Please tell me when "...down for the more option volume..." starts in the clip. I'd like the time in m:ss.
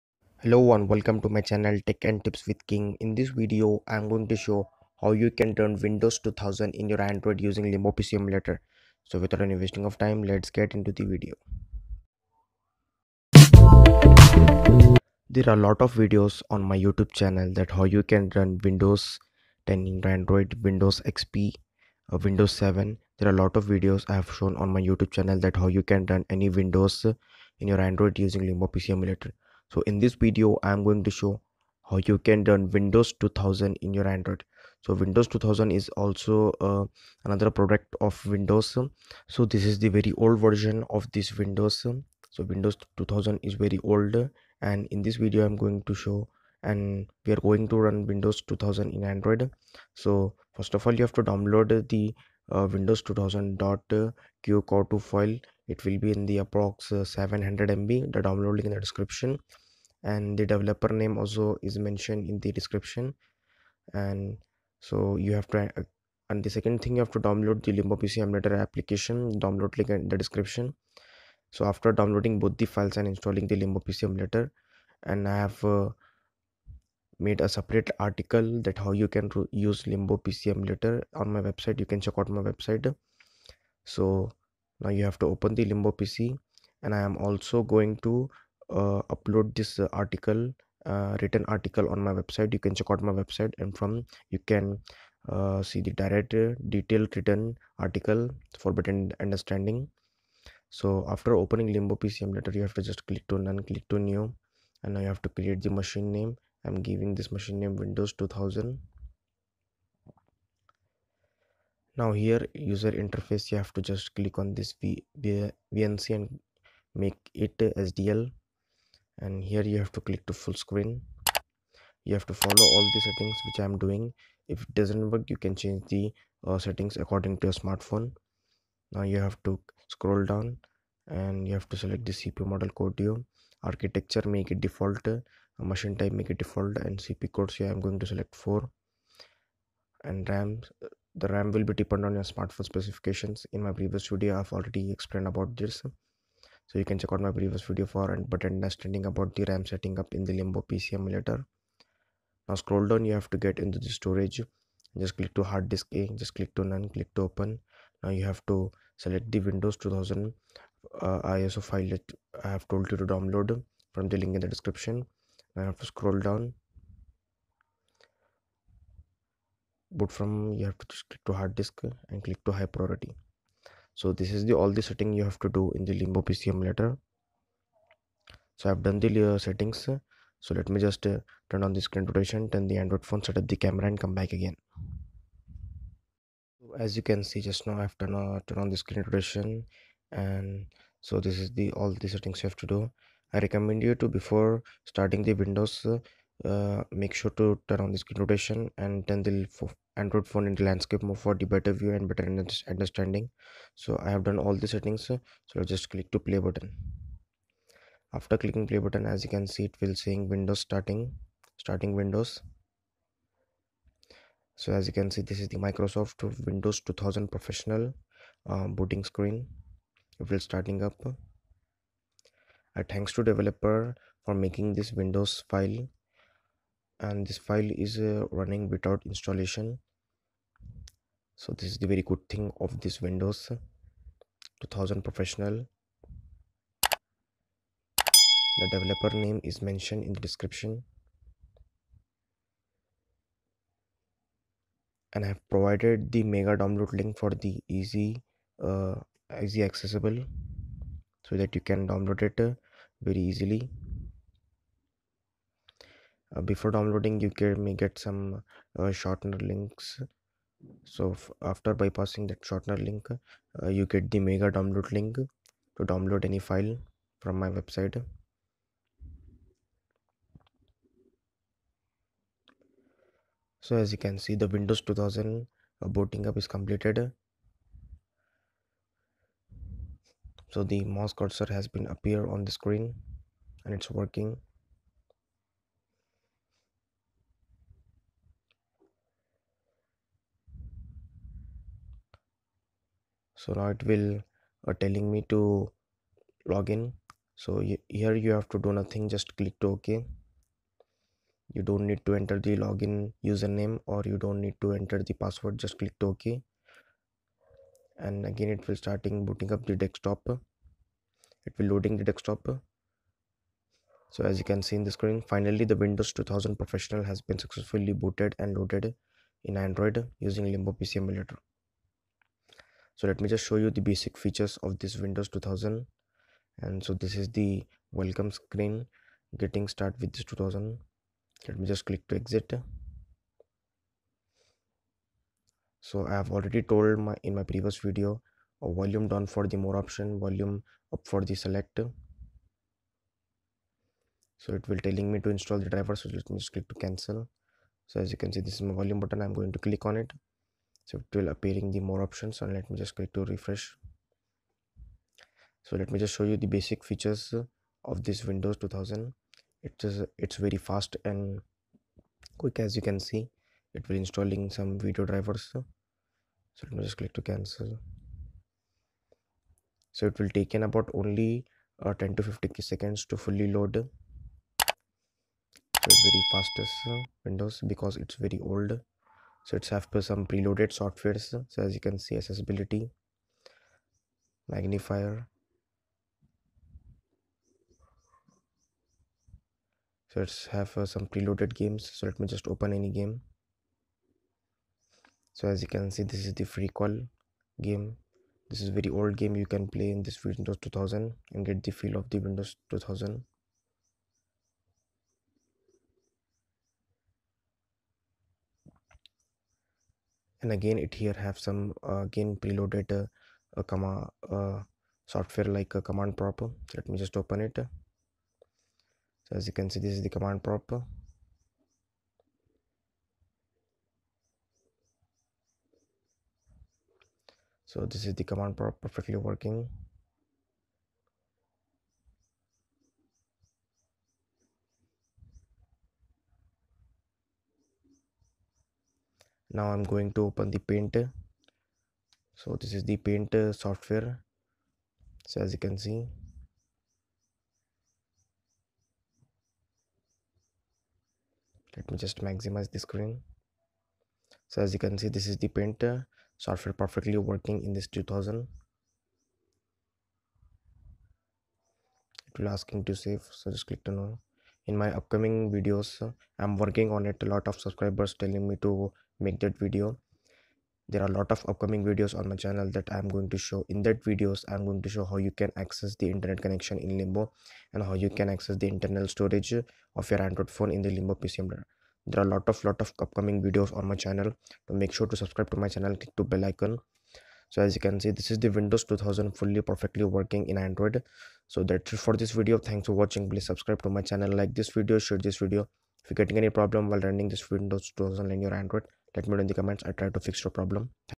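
5:39.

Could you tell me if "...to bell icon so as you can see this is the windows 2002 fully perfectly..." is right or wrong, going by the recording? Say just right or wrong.
wrong.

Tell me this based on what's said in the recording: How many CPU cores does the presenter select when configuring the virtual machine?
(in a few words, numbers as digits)
4.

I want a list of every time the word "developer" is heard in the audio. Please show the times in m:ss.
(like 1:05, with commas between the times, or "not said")
1:00, 3:43, 3:58.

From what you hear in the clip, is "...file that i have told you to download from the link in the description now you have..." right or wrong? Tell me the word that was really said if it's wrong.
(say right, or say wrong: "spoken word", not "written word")
right.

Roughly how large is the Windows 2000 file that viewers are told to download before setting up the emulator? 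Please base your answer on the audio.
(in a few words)
700 MB.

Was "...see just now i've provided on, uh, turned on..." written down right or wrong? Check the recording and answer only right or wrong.
wrong.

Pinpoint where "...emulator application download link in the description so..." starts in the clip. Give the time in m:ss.
1:08.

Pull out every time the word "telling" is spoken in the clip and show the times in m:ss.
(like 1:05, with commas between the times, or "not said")
4:54, 5:44, 7:48.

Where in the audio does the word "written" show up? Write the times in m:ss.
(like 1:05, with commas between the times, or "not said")
1:31, 1:37.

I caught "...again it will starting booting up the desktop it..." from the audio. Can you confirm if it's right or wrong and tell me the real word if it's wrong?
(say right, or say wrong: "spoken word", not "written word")
right.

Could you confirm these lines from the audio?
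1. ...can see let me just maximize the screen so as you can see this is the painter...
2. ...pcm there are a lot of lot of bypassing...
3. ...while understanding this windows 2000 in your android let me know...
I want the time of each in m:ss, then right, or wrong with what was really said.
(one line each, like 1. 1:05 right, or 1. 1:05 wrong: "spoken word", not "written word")
1. 7:25 right
2. 8:01 wrong: "upcoming", not "bypassing"
3. 8:16 wrong: "running", not "understanding".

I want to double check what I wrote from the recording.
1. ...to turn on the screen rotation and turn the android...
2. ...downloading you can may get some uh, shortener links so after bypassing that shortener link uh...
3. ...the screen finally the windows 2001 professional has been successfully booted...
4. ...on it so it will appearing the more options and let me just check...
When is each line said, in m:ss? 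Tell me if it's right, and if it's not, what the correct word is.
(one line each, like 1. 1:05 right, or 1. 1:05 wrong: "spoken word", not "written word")
1. 3:17 right
2. 4:16 right
3. 5:14 wrong: "2000", not "2001"
4. 5:49 wrong: "click", not "check".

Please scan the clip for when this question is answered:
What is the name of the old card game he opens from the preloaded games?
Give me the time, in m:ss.
6:36.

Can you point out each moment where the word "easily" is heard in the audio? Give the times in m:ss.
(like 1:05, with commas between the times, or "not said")
4:13.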